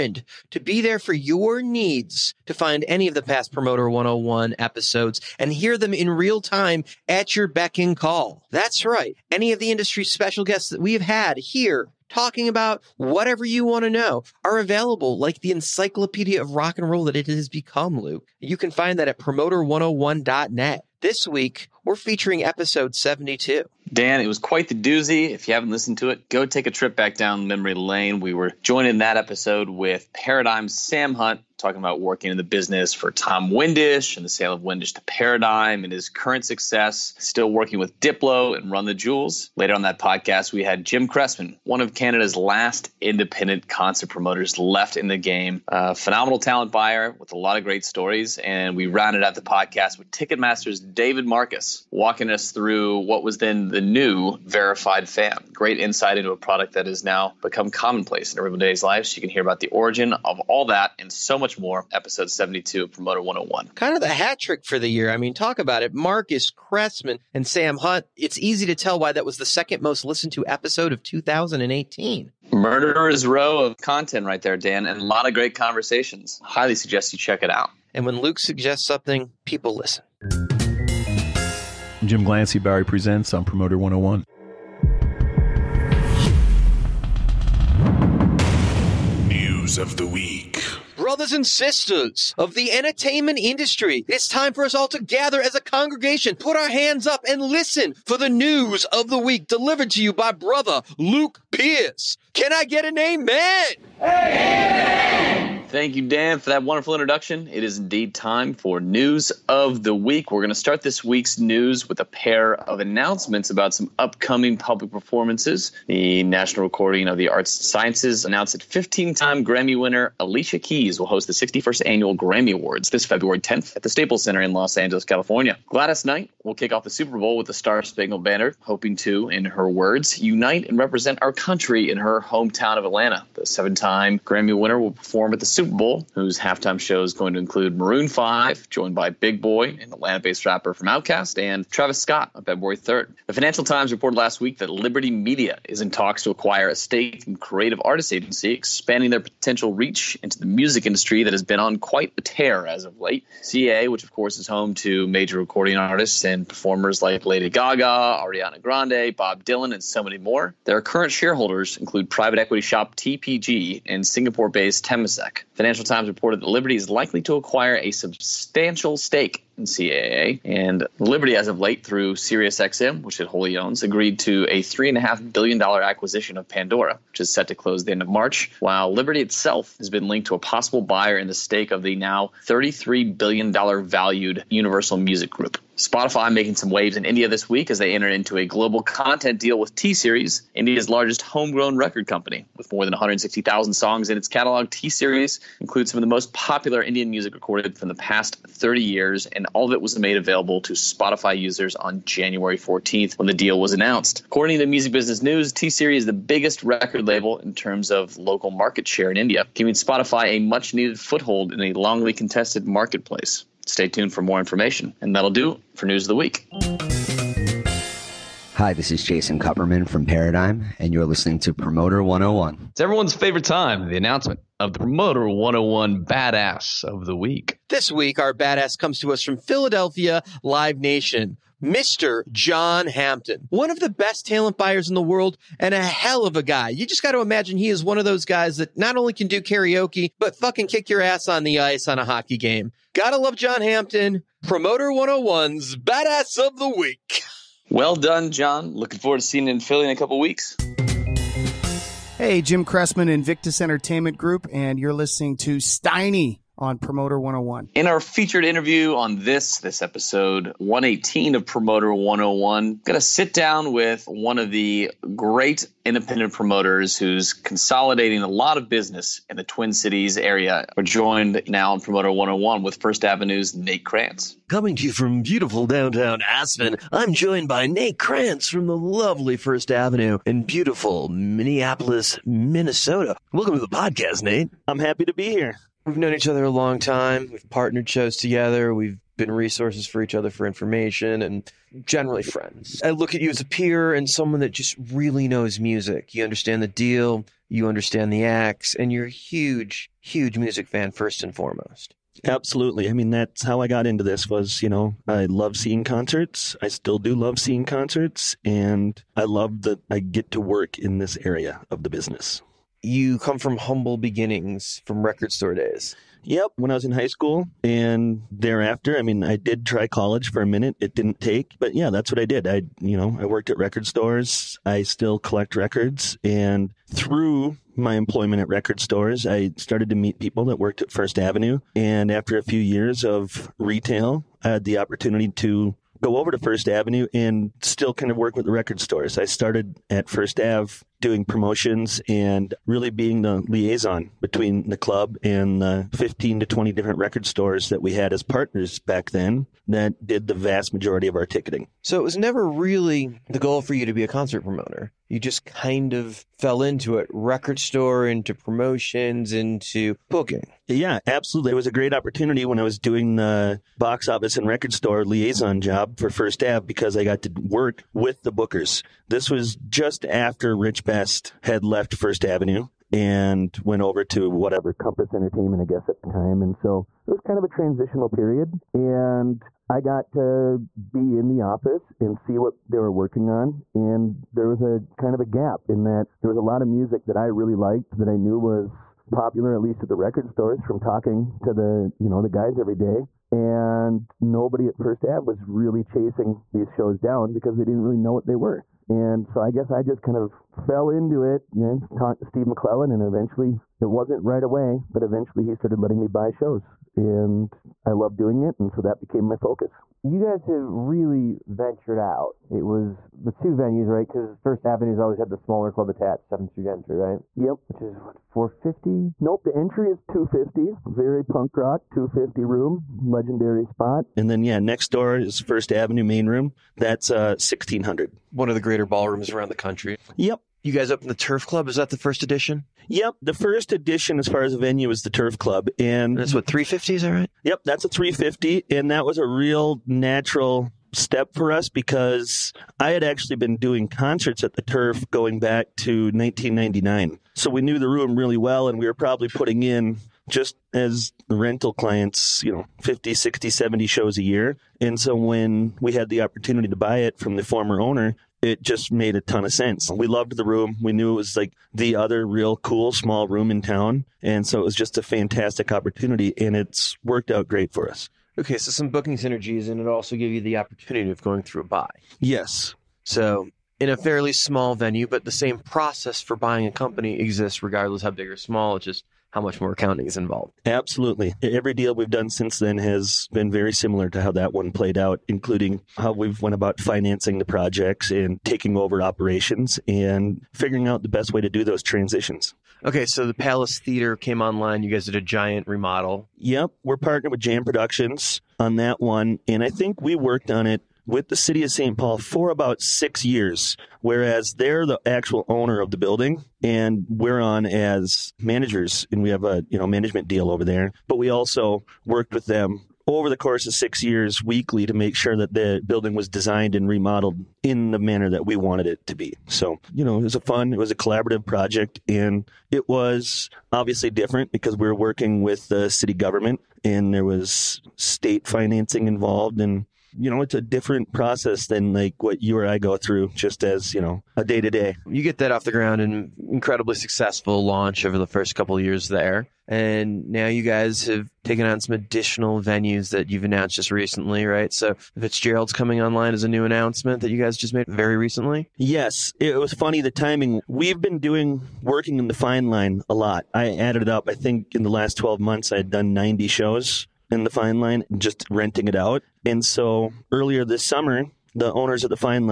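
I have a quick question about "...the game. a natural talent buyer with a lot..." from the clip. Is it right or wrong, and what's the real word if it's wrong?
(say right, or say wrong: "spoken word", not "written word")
wrong: "phenomenal", not "natural".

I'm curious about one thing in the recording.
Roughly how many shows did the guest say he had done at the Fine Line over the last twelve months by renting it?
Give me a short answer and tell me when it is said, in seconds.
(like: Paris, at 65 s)
90, at 556 s.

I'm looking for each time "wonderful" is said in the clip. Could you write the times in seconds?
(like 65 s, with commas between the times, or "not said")
106 s.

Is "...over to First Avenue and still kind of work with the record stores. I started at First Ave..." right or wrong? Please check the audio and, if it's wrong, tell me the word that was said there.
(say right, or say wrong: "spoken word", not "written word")
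right.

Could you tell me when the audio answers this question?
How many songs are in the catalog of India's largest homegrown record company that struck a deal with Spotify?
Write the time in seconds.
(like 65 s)
192 s.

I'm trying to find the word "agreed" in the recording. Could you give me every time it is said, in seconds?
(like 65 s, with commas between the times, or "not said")
173 s.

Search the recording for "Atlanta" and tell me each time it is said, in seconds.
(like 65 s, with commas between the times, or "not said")
132 s, 139 s.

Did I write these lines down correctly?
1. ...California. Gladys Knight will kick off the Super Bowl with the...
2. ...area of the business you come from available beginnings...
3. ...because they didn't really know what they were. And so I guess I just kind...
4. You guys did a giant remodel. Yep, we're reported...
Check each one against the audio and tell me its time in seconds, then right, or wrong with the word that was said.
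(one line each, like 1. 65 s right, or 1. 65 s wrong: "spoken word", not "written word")
1. 125 s right
2. 311 s wrong: "humble", not "available"
3. 397 s right
4. 494 s wrong: "partnered", not "reported".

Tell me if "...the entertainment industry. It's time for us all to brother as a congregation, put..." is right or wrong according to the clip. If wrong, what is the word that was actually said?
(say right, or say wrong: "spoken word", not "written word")
wrong: "gather", not "brother".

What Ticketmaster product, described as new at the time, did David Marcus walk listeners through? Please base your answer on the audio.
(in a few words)
verified fan.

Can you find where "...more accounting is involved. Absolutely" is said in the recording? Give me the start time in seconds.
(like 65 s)
479 s.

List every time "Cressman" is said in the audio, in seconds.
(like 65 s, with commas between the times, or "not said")
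41 s, 66 s, 252 s.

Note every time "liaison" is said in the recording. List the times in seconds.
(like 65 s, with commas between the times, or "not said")
343 s, 365 s.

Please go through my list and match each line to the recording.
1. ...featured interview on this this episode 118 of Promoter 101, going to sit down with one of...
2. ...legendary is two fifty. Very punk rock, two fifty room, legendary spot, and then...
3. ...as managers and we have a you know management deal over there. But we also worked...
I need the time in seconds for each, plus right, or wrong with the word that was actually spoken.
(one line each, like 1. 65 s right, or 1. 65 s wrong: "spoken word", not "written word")
1. 257 s right
2. 419 s wrong: "entry", not "legendary"
3. 507 s right.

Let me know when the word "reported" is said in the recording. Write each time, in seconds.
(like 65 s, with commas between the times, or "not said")
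143 s, 166 s.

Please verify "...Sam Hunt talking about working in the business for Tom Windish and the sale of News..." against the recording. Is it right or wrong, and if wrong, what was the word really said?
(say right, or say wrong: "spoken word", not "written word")
wrong: "Windish", not "News".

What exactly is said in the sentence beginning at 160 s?
Their current shareholders include private equity shop TPG and Singapore based Temasek.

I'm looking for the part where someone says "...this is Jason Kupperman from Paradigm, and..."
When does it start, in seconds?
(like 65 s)
218 s.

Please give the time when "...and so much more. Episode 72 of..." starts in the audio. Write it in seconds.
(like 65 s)
60 s.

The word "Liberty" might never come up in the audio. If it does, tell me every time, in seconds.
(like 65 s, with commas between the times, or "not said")
144 s, 166 s, 170 s, 178 s.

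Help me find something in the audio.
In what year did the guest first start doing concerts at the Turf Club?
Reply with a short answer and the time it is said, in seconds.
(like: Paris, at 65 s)
1999, at 446 s.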